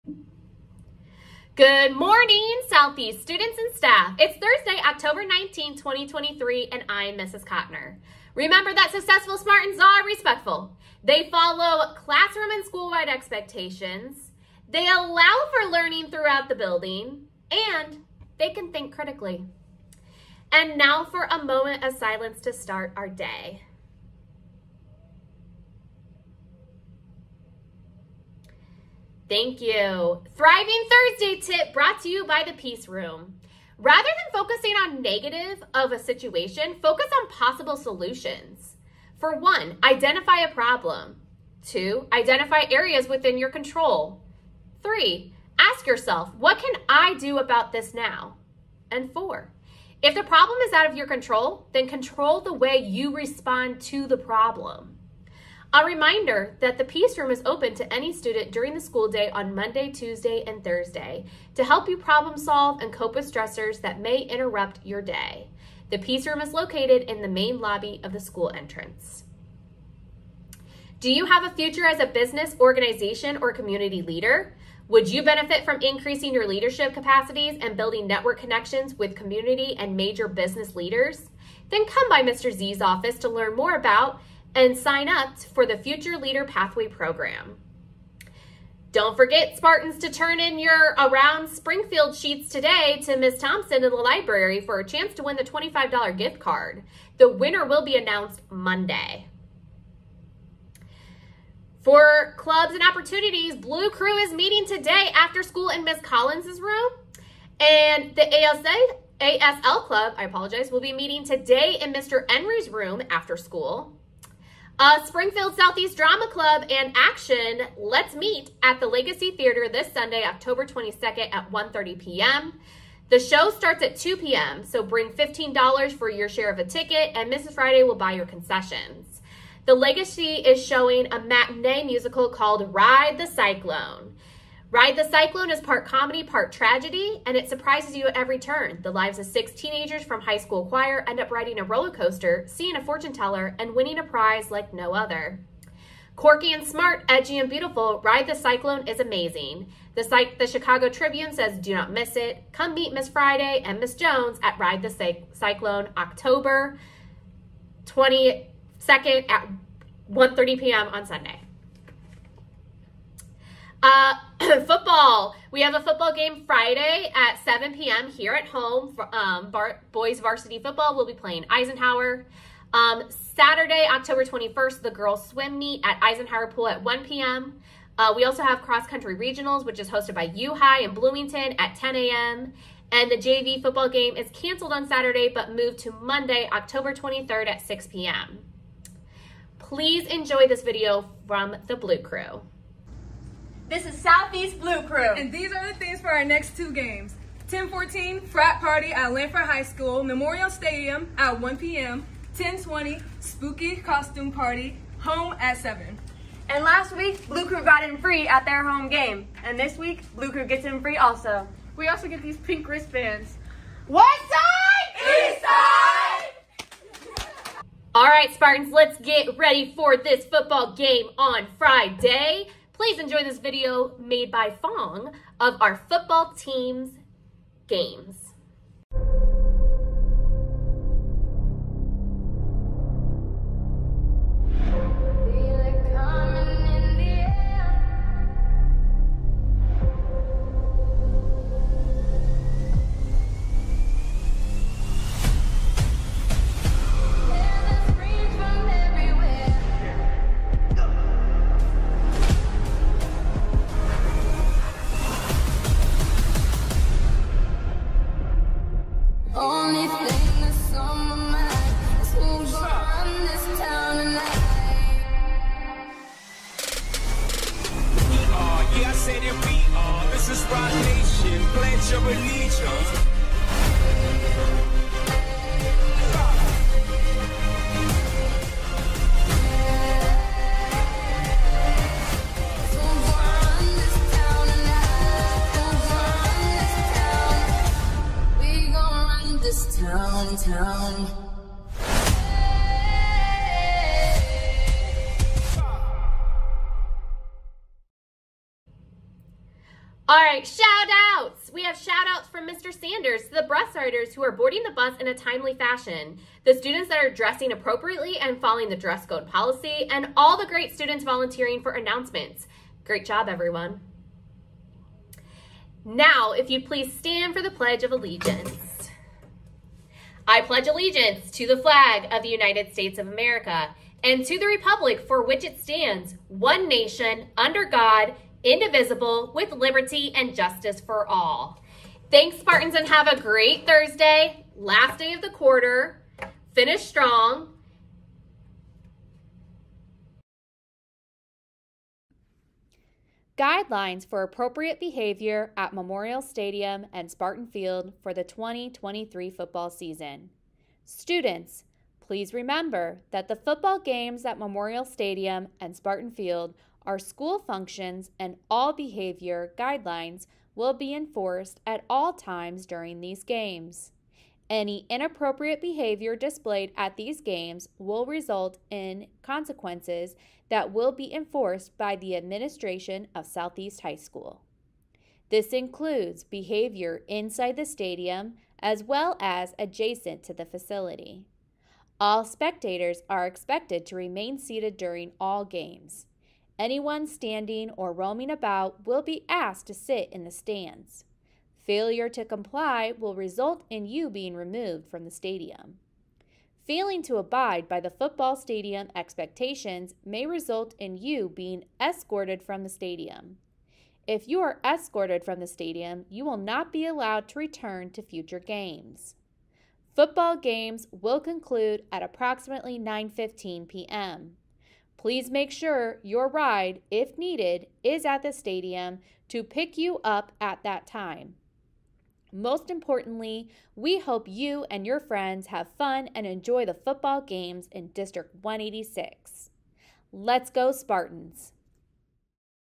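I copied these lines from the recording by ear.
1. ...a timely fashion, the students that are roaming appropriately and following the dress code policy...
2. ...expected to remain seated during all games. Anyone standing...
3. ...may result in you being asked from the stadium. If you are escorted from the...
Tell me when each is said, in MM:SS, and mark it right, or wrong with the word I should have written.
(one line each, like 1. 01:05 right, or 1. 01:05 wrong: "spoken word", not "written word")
1. 05:05 wrong: "dressing", not "roaming"
2. 06:23 right
3. 06:40 wrong: "escorted", not "asked".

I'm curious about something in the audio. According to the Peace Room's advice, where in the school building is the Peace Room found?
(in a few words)
Main lobby.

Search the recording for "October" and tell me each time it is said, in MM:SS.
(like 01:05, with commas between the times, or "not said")
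00:04, 02:00, 02:35, 02:53, 03:06.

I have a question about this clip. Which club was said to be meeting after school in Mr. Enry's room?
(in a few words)
ASL Club.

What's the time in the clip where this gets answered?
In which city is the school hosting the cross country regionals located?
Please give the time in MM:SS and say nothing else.
03:00.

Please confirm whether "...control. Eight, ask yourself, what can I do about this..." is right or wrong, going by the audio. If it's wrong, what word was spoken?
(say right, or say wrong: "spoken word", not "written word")
wrong: "Three", not "Eight".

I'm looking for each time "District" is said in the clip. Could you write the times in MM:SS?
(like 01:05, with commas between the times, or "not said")
07:07.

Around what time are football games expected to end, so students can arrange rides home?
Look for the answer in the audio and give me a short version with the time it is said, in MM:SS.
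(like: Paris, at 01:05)
9:15 p.m., at 06:52.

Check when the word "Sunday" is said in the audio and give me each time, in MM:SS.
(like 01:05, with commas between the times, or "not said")
01:59, 02:41.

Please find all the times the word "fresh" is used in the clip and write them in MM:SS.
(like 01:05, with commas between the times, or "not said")
not said.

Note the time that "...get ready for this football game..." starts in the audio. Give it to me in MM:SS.
03:38.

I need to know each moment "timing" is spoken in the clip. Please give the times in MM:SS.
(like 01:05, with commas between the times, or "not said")
not said.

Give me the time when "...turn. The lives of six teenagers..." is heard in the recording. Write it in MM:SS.
02:18.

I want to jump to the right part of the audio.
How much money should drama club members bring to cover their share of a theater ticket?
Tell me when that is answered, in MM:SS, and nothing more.
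02:05.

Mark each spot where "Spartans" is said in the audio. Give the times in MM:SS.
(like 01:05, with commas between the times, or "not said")
00:09, 01:29, 03:38, 05:32, 05:47, 05:55, 07:10.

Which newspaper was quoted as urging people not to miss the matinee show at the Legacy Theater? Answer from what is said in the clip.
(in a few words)
Chicago Tribune.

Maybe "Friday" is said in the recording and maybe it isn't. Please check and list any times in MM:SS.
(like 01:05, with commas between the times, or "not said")
02:07, 02:33, 02:46, 03:41.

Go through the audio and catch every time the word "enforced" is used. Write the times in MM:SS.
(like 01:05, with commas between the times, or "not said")
06:00, 06:11.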